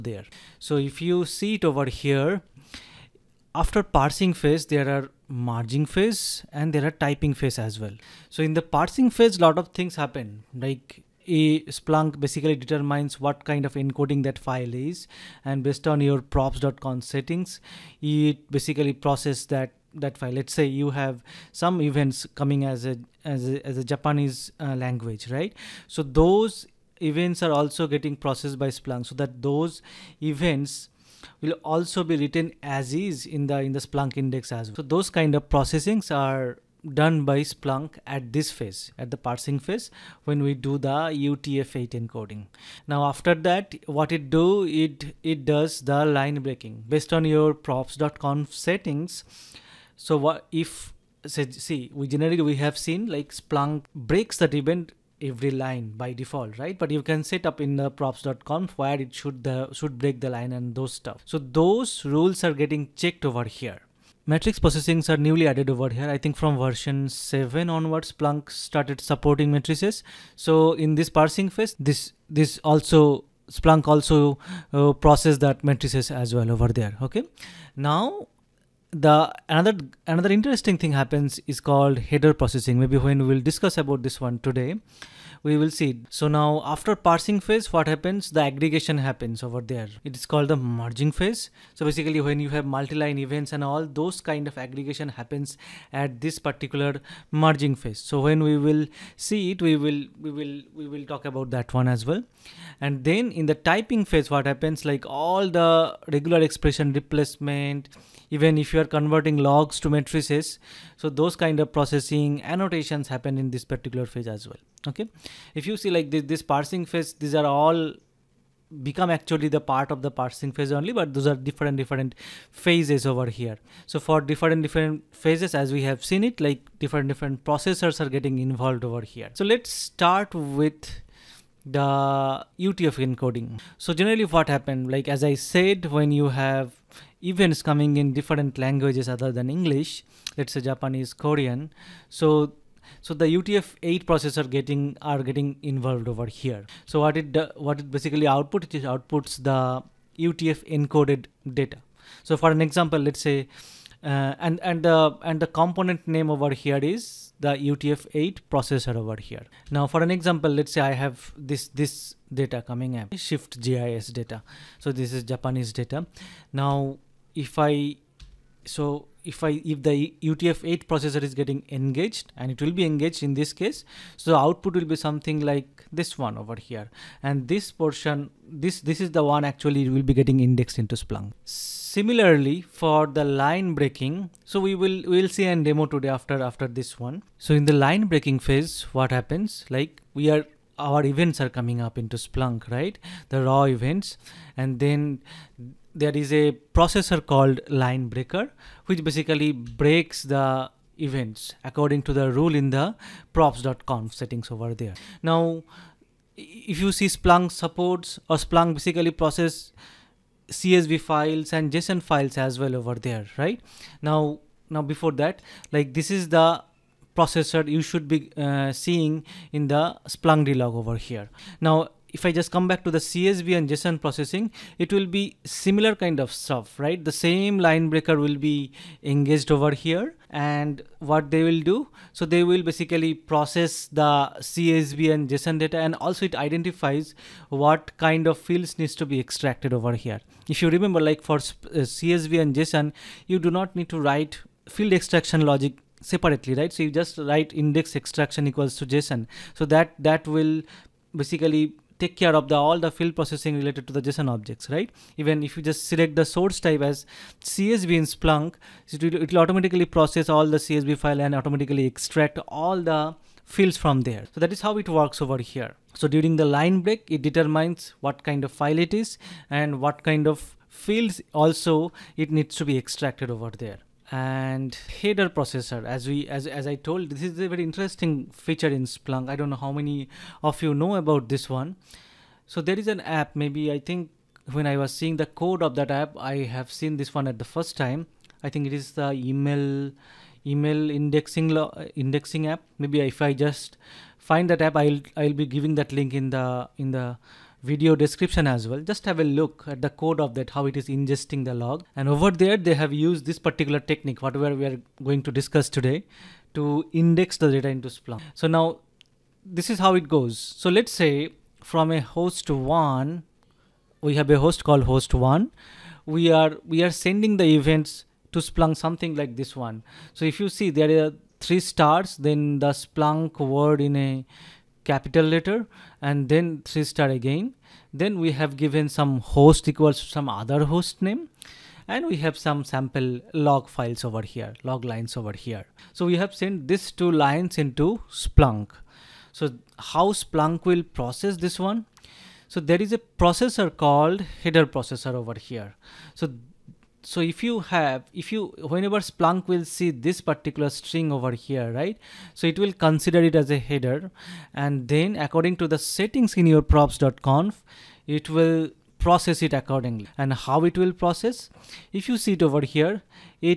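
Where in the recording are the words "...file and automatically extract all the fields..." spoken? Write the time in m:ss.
4:21.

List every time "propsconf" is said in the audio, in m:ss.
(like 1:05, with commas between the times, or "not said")
0:16, 0:47, 0:57, 3:23, 5:56.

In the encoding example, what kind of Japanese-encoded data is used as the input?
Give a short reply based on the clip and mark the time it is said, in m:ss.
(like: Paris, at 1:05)
Shift JIS, at 2:43.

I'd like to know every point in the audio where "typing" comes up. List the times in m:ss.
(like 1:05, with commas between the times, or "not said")
0:06, 1:43.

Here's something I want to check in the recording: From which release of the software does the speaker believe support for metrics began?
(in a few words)
Version 7.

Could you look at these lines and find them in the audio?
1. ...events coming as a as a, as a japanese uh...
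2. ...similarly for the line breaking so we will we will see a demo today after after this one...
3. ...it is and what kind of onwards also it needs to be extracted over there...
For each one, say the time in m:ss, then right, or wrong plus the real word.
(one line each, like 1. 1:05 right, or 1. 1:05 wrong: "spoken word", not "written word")
1. 0:21 right
2. 3:01 right
3. 4:28 wrong: "fields", not "onwards".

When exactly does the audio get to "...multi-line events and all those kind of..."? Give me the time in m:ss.
1:32.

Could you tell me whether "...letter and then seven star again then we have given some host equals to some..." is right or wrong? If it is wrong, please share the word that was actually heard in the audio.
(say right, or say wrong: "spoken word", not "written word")
wrong: "three", not "seven".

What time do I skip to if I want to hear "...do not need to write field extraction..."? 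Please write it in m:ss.
4:03.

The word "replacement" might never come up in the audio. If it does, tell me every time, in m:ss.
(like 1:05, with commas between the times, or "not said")
1:46.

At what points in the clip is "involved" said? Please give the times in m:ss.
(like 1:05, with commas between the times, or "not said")
2:08, 2:25.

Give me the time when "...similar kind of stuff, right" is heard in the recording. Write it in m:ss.
3:45.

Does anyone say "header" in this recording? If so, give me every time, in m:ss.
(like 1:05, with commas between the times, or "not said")
1:21, 4:35, 5:44, 5:53.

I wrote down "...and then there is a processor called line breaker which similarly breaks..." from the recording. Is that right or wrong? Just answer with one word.
wrong.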